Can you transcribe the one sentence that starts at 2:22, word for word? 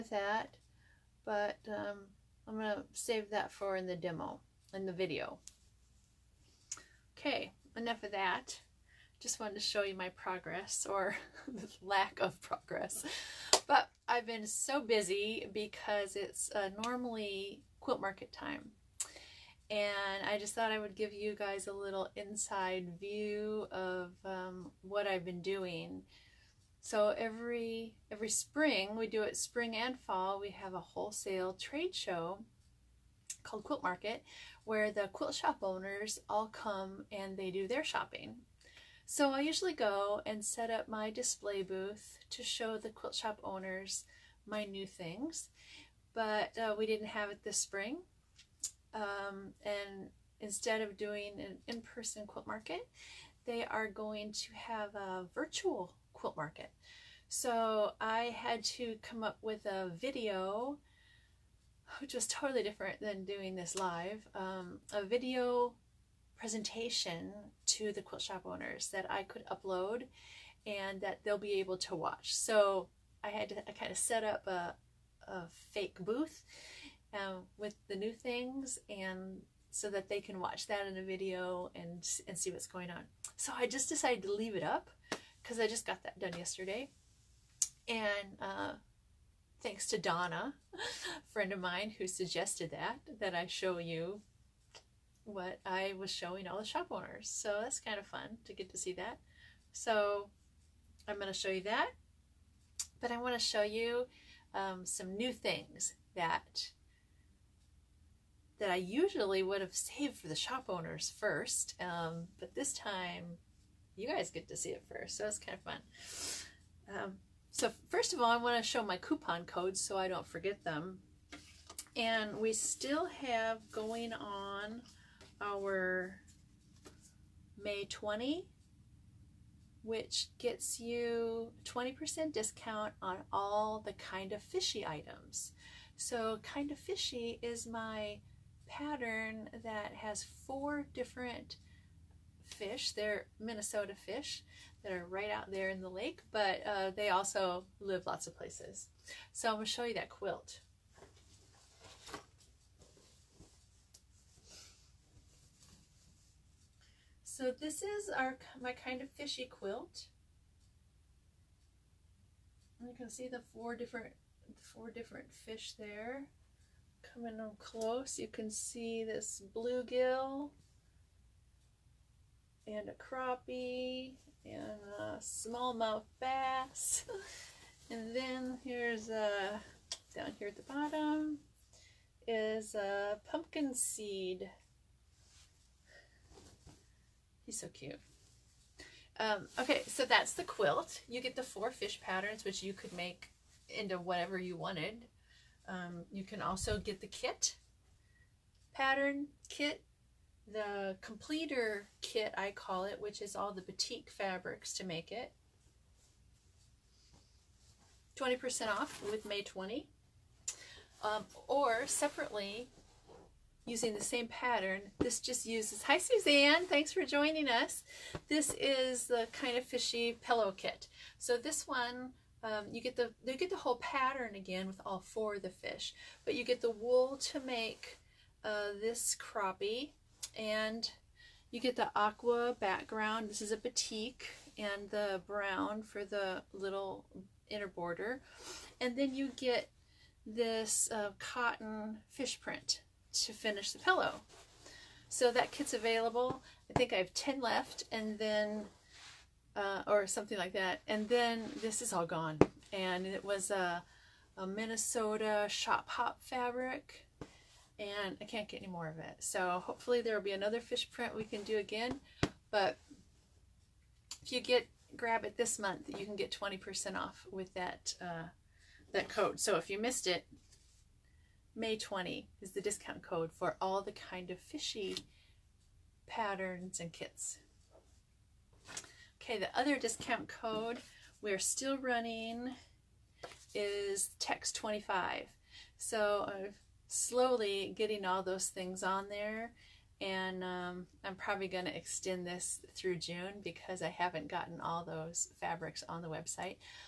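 They're Minnesota fish that are right out there in the lake, but uh, they also live lots of places.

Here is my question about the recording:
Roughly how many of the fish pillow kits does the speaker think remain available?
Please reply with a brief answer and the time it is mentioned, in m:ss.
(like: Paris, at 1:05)
10, at 4:07.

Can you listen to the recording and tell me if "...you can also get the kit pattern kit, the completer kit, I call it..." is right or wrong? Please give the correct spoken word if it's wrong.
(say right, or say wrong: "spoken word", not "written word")
right.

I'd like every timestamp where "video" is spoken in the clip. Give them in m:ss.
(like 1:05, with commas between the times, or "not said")
0:04, 0:59, 1:05, 1:21.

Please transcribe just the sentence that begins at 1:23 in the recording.
So I just decided to leave it up because I just got that done yesterday.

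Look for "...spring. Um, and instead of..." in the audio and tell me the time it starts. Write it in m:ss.
0:47.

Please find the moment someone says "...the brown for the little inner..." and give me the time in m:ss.
3:54.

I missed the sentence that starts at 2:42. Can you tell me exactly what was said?
And you can see the four different four different fish there.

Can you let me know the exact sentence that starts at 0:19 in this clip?
And I just thought I would give you guys a little inside view of um, what I've been doing.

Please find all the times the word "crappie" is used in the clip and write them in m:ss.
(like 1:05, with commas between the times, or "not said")
2:52, 3:49.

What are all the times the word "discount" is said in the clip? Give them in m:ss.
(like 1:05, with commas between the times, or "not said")
2:12, 4:32, 4:39.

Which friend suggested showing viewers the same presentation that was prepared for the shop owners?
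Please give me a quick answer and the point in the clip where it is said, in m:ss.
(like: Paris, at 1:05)
Donna, at 1:29.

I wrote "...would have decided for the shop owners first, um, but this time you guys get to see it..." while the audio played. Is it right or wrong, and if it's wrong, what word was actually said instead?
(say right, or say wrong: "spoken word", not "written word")
wrong: "saved", not "decided".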